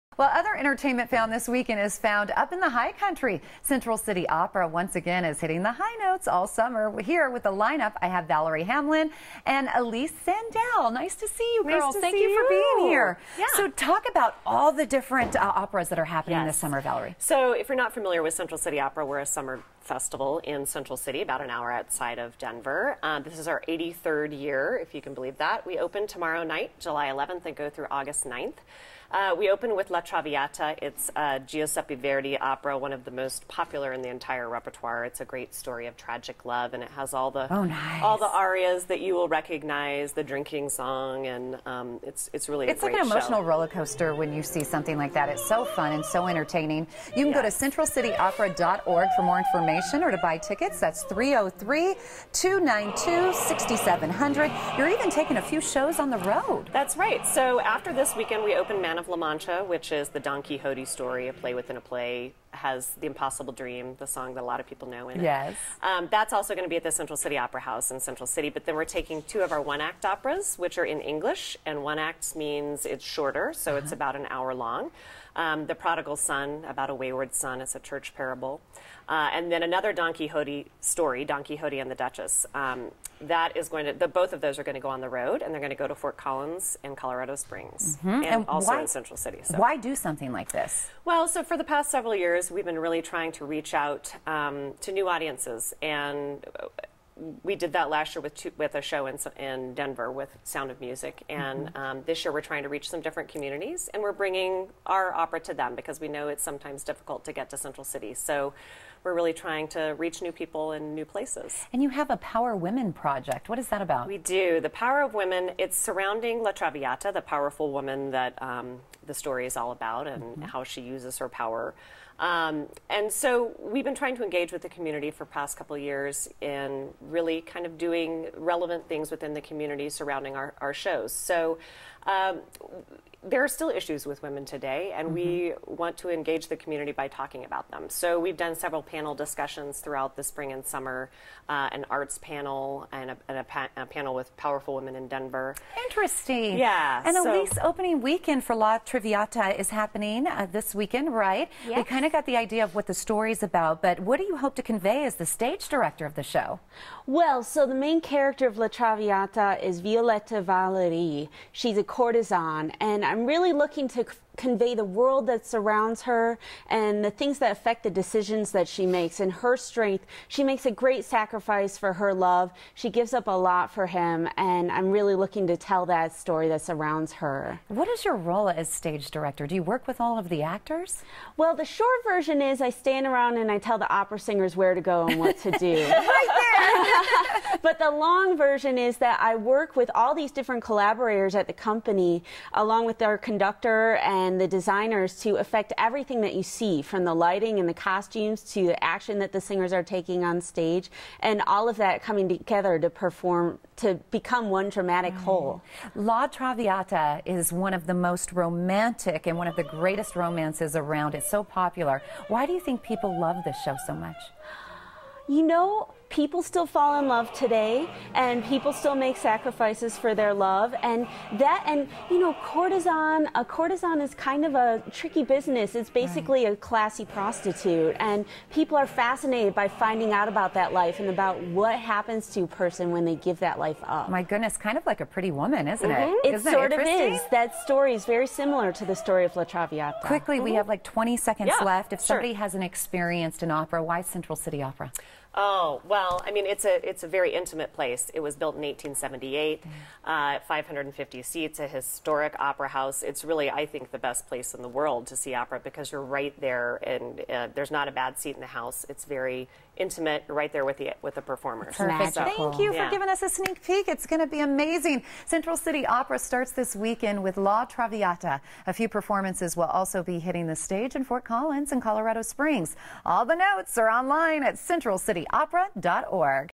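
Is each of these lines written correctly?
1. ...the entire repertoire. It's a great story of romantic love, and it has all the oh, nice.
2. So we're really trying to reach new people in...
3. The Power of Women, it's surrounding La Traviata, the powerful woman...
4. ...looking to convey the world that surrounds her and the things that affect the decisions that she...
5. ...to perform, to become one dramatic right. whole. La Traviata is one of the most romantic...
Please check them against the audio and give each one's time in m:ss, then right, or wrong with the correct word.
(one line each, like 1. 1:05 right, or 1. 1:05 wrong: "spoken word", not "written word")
1. 0:34 wrong: "tragic", not "romantic"
2. 1:48 right
3. 1:54 right
4. 2:43 right
5. 3:22 right.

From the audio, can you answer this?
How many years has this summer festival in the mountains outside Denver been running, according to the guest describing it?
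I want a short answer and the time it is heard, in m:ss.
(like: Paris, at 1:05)
83, at 0:23.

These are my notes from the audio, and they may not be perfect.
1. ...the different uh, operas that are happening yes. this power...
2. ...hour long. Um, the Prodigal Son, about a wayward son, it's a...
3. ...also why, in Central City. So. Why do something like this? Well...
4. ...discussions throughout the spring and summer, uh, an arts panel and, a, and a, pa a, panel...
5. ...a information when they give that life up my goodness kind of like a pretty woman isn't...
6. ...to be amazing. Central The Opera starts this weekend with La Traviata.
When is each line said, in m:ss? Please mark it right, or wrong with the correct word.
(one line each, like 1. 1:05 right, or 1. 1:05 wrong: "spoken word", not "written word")
1. 0:14 wrong: "summer", not "power"
2. 1:14 right
3. 1:28 right
4. 2:19 right
5. 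3:52 wrong: "person", not "information"
6. 4:24 wrong: "City", not "The".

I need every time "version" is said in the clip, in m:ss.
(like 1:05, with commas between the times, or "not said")
3:02, 3:08.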